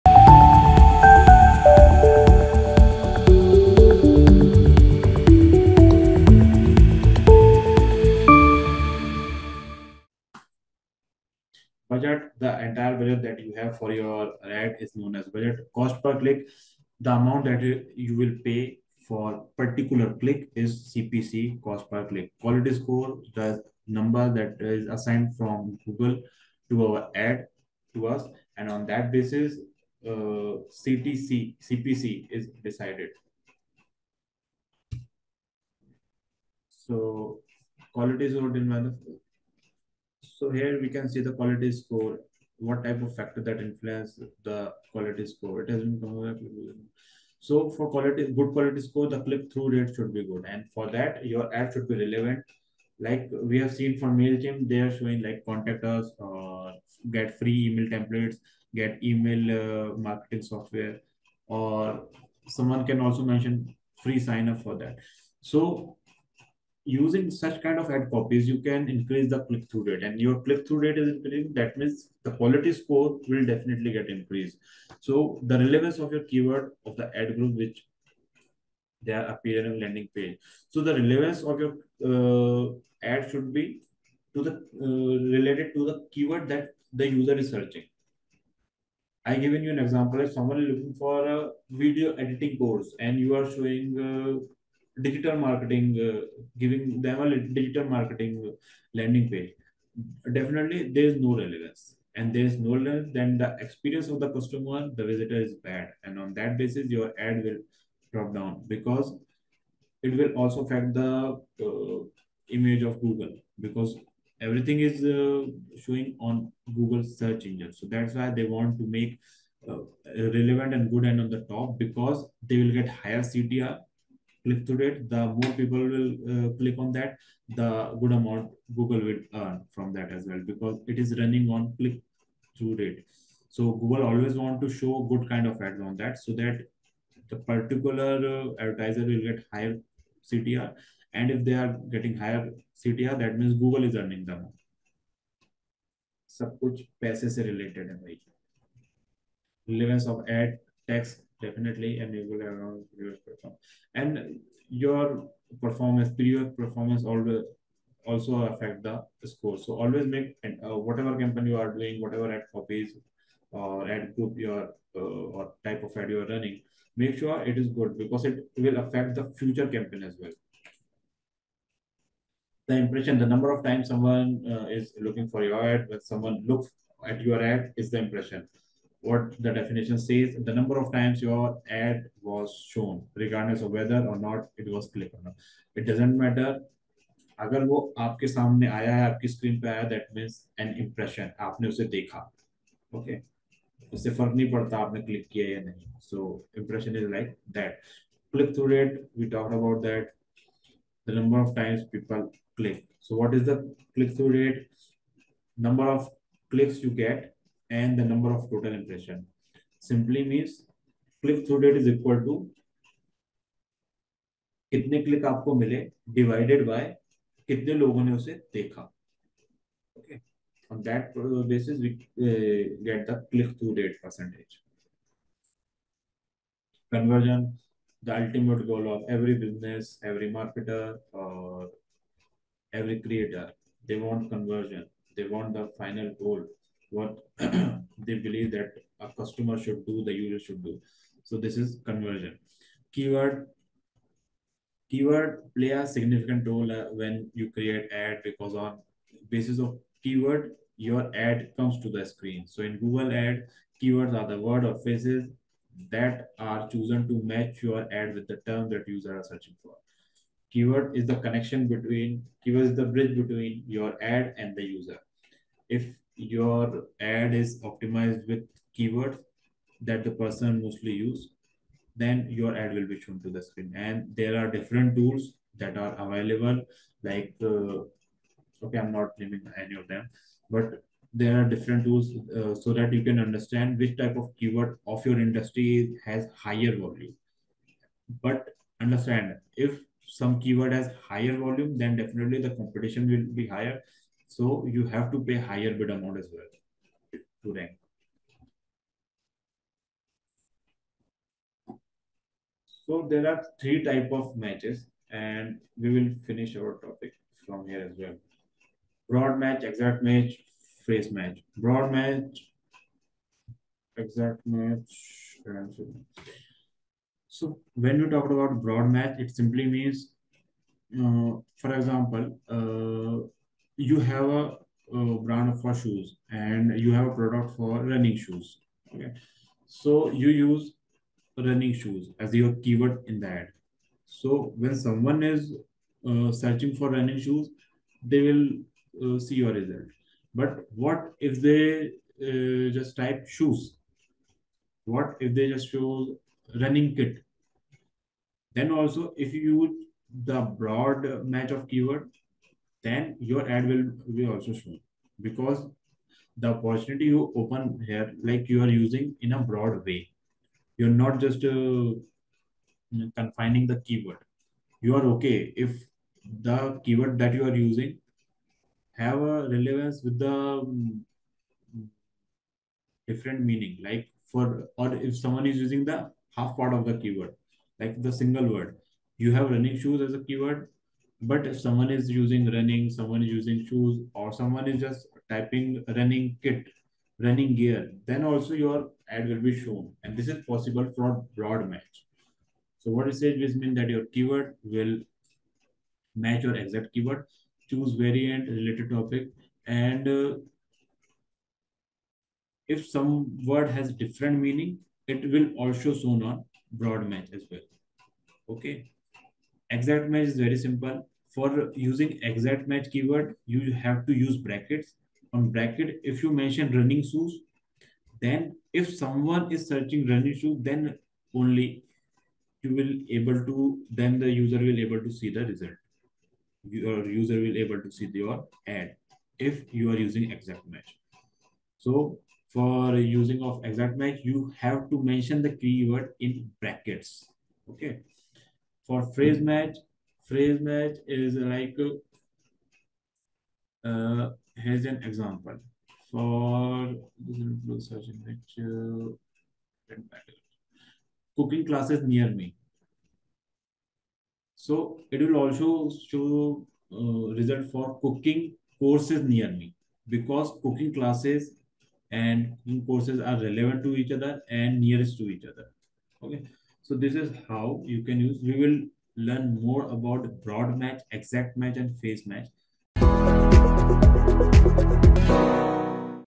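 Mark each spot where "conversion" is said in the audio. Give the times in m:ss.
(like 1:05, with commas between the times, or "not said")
3:46, 3:54, 4:01.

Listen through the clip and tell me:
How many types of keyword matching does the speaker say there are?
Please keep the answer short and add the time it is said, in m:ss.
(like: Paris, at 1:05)
3, at 5:03.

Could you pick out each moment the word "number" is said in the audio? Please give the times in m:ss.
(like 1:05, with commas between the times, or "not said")
0:23, 2:53, 3:00, 3:28.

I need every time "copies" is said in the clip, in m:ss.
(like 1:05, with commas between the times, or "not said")
1:08, 2:42.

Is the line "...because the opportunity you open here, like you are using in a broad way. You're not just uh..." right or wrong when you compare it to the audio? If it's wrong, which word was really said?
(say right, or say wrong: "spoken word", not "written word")
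right.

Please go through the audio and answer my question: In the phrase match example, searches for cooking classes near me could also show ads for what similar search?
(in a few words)
Cooking courses near me.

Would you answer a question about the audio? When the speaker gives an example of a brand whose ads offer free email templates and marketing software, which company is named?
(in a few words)
Mailchimp.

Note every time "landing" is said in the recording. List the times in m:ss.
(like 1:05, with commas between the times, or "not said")
1:19, 1:38.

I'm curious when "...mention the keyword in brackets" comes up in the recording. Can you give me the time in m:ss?
7:15.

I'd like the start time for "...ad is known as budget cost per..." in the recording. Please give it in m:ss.
0:14.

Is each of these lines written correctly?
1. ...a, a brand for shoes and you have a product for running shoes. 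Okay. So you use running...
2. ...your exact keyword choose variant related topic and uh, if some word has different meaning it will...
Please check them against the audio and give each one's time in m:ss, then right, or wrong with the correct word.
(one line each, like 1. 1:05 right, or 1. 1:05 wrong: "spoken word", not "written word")
1. 5:24 right
2. 6:36 right.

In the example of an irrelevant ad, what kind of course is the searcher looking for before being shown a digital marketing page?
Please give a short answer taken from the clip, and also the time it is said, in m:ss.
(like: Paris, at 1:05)
Video editing course, at 1:31.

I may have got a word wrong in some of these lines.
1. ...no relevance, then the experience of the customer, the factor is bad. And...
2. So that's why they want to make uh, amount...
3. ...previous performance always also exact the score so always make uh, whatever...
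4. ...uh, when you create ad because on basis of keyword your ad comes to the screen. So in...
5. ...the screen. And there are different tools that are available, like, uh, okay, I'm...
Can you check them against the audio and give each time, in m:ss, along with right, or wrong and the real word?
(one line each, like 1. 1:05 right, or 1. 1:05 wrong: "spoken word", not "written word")
1. 1:42 wrong: "visitor", not "factor"
2. 1:57 wrong: "relevant", not "amount"
3. 2:36 wrong: "affect", not "exact"
4. 4:06 right
5. 4:33 right.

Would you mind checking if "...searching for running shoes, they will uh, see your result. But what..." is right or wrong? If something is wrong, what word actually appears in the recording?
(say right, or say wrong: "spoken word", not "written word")
right.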